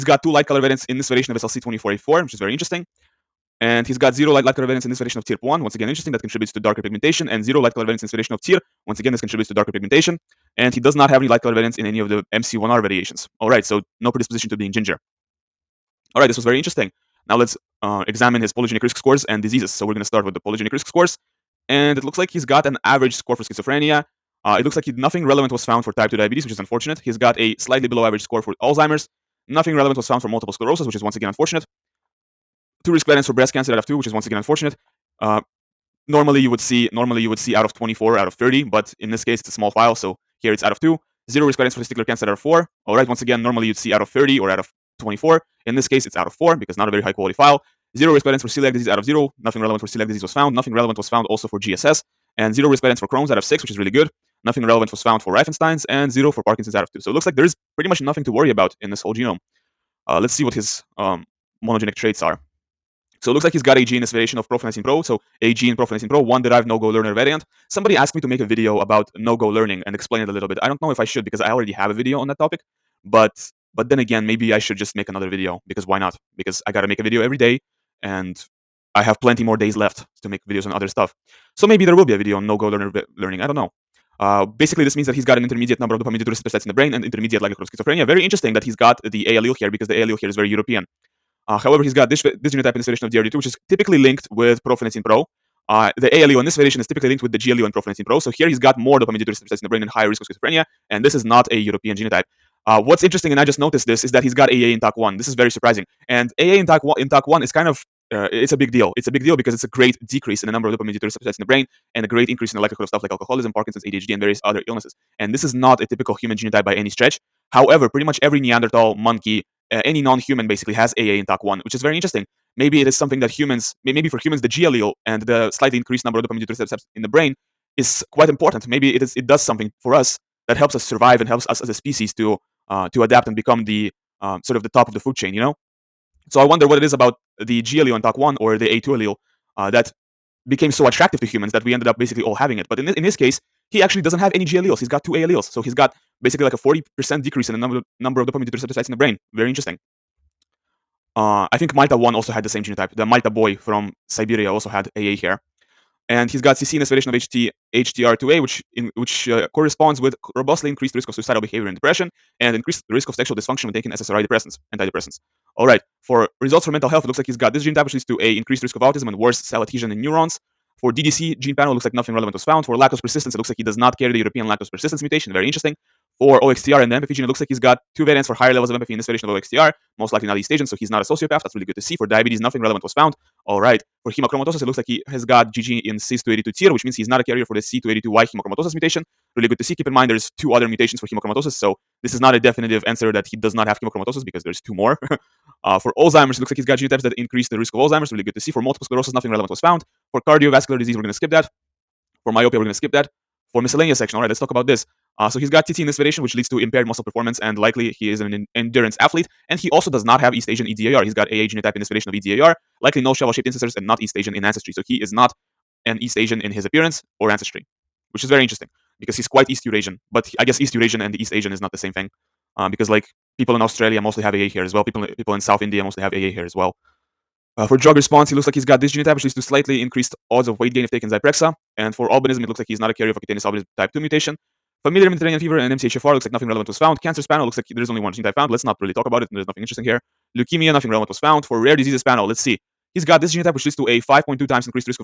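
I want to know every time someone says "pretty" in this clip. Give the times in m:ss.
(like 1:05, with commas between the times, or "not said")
0:57, 1:57.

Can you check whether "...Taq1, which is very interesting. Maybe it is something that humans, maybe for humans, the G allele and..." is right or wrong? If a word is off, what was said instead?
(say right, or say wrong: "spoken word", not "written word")
right.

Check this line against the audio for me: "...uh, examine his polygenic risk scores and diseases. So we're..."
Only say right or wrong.
right.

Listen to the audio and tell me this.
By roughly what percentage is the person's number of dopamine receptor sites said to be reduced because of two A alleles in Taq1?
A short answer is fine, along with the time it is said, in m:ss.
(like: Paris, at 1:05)
40%, at 2:26.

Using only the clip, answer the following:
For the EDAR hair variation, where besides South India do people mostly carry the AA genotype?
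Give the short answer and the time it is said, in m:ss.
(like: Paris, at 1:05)
Australia, at 3:43.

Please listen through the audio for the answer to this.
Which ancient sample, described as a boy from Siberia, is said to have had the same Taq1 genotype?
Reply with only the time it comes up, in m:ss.
2:31.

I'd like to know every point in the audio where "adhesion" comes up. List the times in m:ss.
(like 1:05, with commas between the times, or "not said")
2:49.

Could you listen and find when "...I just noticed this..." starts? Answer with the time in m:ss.
1:43.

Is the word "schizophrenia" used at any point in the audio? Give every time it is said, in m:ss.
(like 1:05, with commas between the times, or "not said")
0:23, 1:27, 1:40.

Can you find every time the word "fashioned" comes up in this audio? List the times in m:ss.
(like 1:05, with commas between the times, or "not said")
not said.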